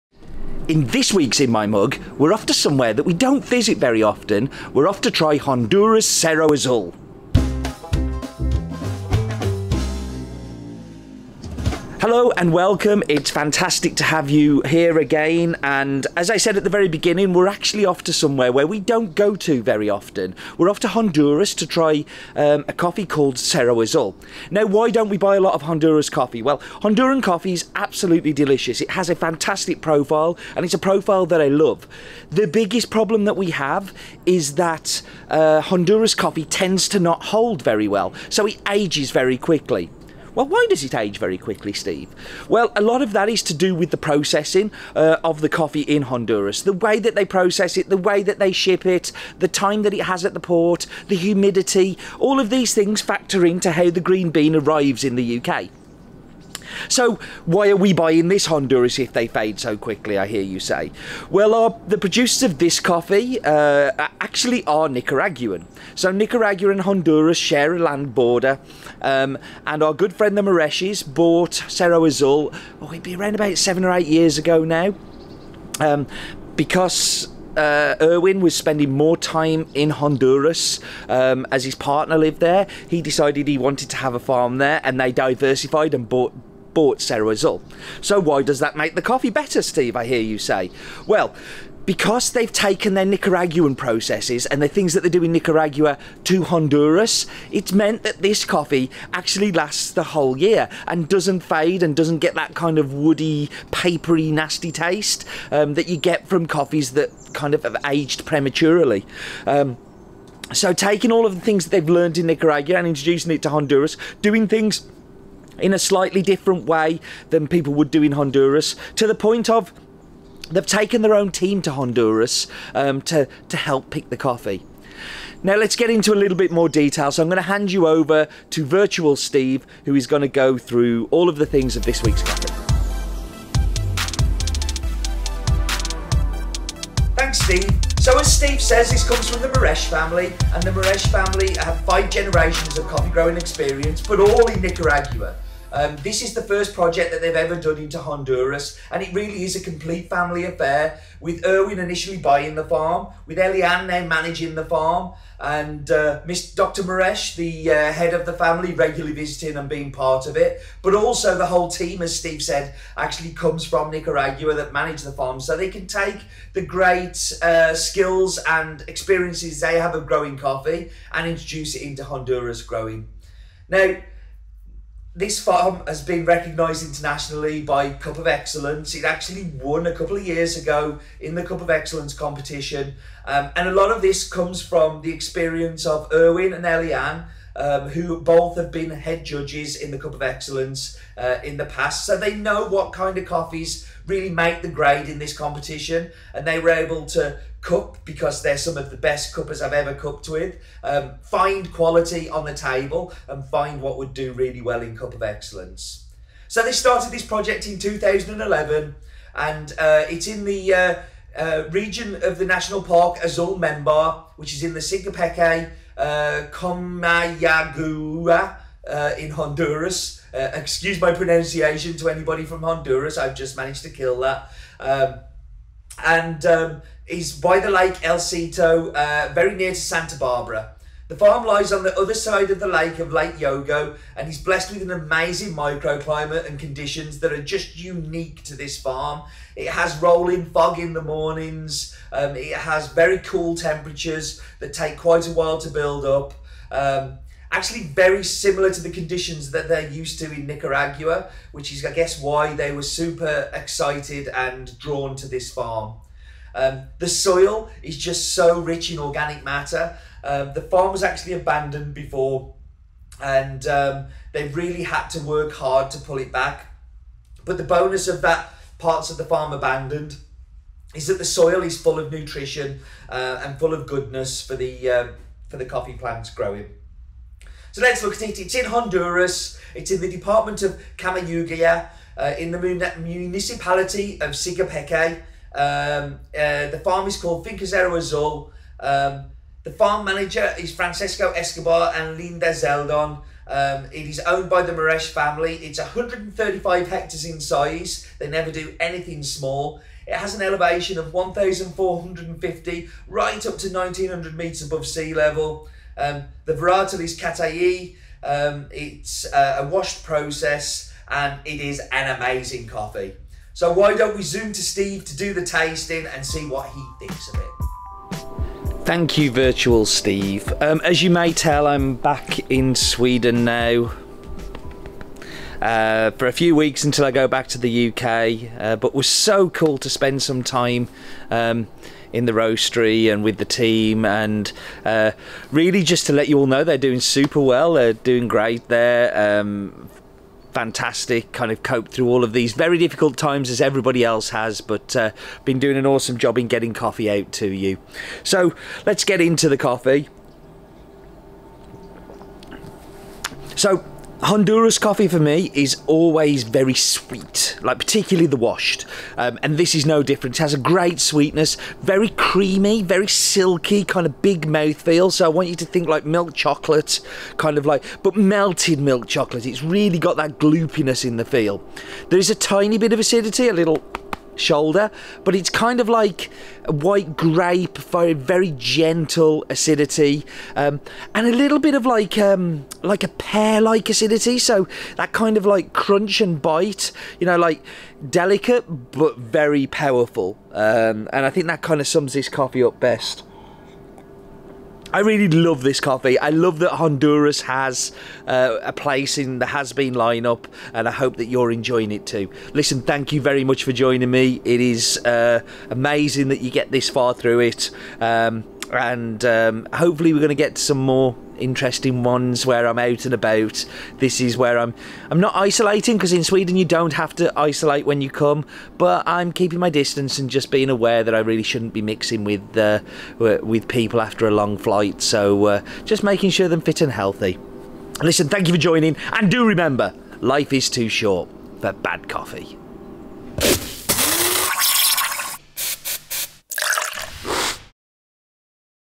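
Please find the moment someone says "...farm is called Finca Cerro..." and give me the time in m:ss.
4:46.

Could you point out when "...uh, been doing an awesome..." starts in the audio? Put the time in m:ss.
5:44.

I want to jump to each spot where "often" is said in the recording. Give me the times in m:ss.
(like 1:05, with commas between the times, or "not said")
0:04, 0:19.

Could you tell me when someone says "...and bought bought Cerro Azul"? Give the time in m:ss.
1:25.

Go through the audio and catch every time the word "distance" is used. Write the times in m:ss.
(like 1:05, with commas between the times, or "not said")
6:59.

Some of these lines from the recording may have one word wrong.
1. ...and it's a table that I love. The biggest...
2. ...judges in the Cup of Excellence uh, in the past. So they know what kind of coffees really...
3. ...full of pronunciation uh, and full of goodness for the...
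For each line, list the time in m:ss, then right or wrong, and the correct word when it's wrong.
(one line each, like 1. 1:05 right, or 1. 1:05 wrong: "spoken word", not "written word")
1. 0:30 wrong: "profile", not "table"
2. 3:09 right
3. 4:31 wrong: "nutrition", not "pronunciation".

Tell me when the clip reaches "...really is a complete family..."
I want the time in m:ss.
2:29.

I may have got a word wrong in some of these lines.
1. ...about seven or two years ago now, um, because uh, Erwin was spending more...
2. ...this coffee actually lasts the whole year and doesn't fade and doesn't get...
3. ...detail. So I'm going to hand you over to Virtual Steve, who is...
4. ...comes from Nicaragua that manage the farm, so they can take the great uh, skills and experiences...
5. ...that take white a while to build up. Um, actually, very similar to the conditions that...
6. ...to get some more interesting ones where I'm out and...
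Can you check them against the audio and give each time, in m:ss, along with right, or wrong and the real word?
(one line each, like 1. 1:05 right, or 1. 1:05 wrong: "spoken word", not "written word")
1. 1:13 wrong: "eight", not "two"
2. 1:38 right
3. 2:06 right
4. 2:43 right
5. 4:04 wrong: "quite", not "white"
6. 6:50 right.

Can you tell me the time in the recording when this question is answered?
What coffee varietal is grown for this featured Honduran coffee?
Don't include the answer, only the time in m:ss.
5:07.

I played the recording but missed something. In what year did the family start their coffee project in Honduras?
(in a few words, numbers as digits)
2011.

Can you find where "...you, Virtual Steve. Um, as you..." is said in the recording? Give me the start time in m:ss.
5:19.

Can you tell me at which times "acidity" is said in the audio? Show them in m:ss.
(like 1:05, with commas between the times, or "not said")
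6:12, 6:19, 6:23.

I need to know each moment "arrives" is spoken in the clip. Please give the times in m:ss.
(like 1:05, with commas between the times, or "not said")
0:54.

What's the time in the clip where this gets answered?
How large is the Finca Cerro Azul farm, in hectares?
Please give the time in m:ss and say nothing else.
4:55.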